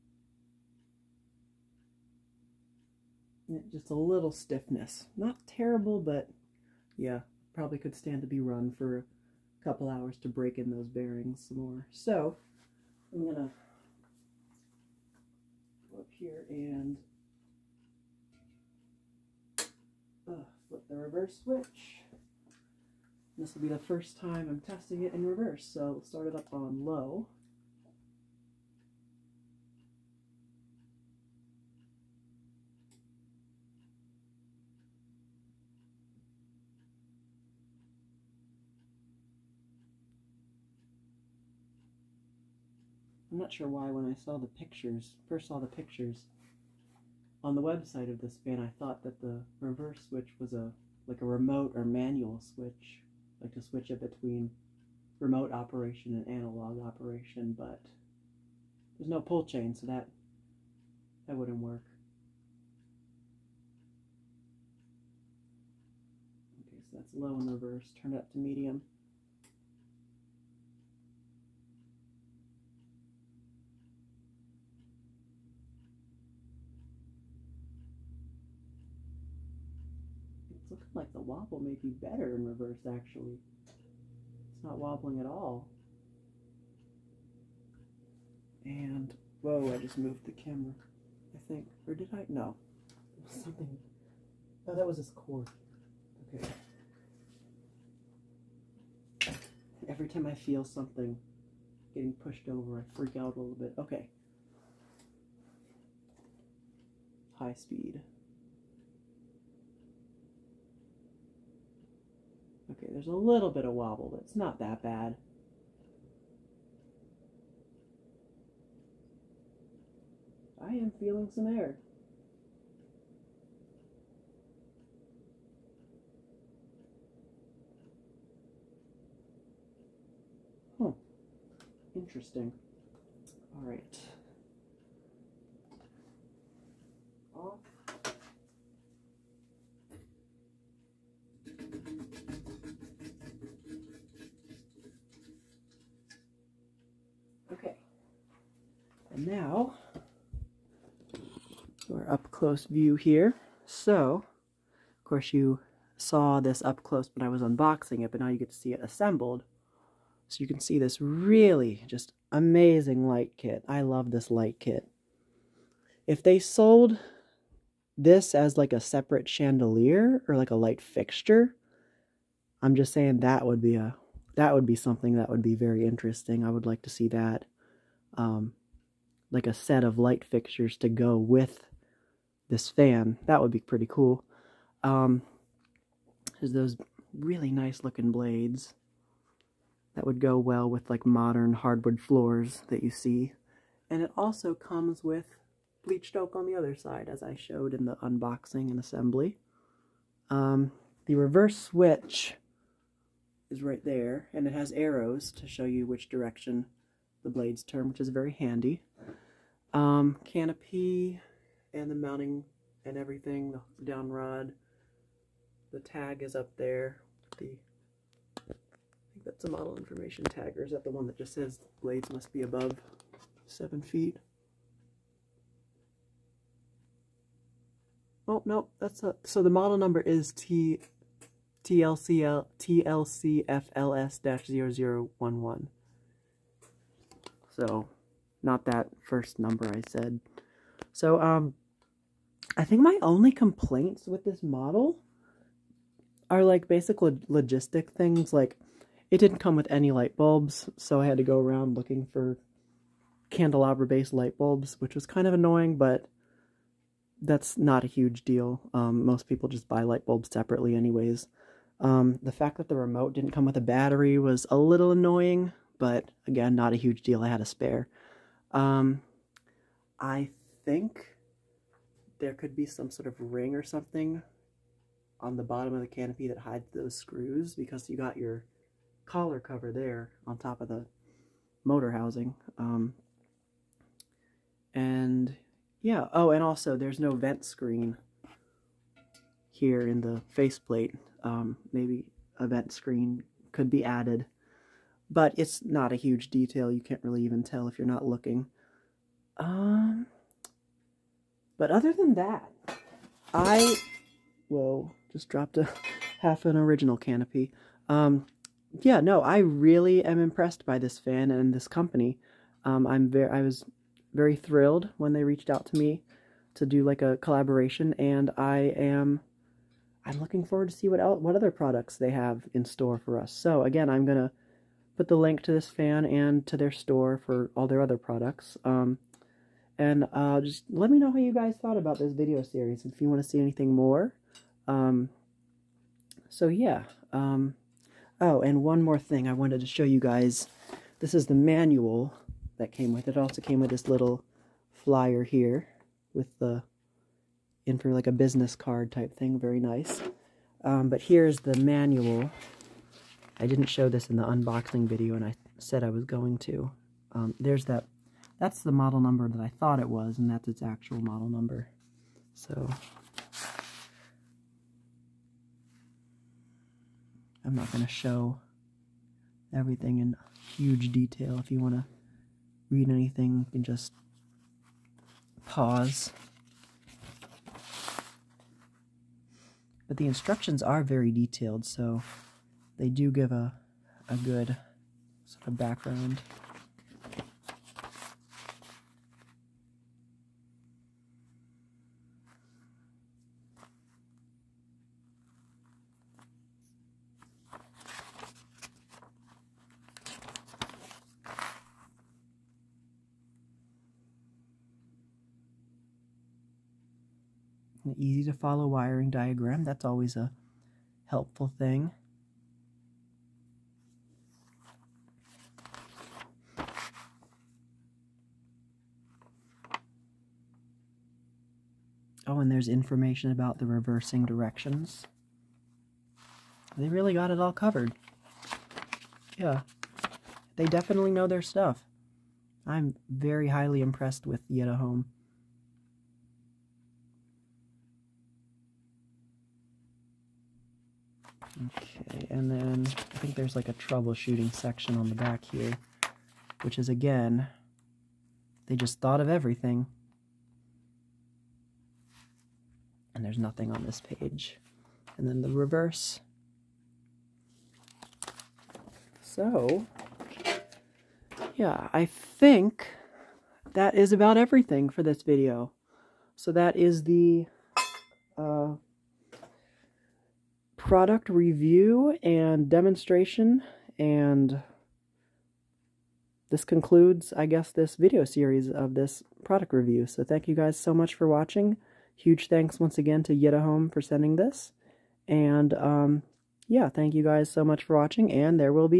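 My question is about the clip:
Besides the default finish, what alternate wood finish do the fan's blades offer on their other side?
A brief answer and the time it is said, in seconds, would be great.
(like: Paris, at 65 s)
bleached oak, at 195 s.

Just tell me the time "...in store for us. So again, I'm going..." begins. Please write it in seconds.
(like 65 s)
322 s.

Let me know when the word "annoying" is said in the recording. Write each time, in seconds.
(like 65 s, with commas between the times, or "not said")
255 s, 264 s.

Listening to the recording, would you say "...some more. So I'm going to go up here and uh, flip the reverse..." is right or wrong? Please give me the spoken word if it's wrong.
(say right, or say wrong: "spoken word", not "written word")
right.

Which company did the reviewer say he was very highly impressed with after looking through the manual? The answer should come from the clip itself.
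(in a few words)
Yitahome.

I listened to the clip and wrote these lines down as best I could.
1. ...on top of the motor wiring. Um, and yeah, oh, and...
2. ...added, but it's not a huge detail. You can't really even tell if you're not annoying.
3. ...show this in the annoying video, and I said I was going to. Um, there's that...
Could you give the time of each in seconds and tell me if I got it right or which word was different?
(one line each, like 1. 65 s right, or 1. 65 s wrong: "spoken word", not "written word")
1. 280 s wrong: "housing", not "wiring"
2. 293 s wrong: "looking", not "annoying"
3. 353 s wrong: "unboxing", not "annoying".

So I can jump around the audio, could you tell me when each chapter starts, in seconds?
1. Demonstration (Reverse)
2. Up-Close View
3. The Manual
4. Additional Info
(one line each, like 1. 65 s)
1. 19 s
2. 149 s
3. 349 s
4. 459 s.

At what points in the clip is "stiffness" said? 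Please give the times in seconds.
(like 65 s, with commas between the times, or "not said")
4 s.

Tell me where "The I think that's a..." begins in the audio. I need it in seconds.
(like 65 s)
217 s.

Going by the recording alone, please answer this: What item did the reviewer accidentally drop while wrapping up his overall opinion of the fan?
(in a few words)
half an original canopy.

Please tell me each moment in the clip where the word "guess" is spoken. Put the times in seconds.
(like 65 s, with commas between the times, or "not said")
477 s.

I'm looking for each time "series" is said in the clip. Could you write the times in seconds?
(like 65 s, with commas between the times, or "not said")
332 s, 478 s.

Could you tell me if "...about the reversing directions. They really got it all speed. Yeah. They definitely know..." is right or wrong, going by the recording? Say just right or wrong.
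wrong.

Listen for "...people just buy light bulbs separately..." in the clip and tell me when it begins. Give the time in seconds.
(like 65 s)
259 s.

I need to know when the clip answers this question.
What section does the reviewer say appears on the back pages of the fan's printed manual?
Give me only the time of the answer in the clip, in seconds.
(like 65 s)
443 s.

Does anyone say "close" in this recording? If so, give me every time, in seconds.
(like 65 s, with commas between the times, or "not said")
152 s, 156 s.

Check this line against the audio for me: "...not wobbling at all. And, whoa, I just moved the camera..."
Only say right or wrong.
right.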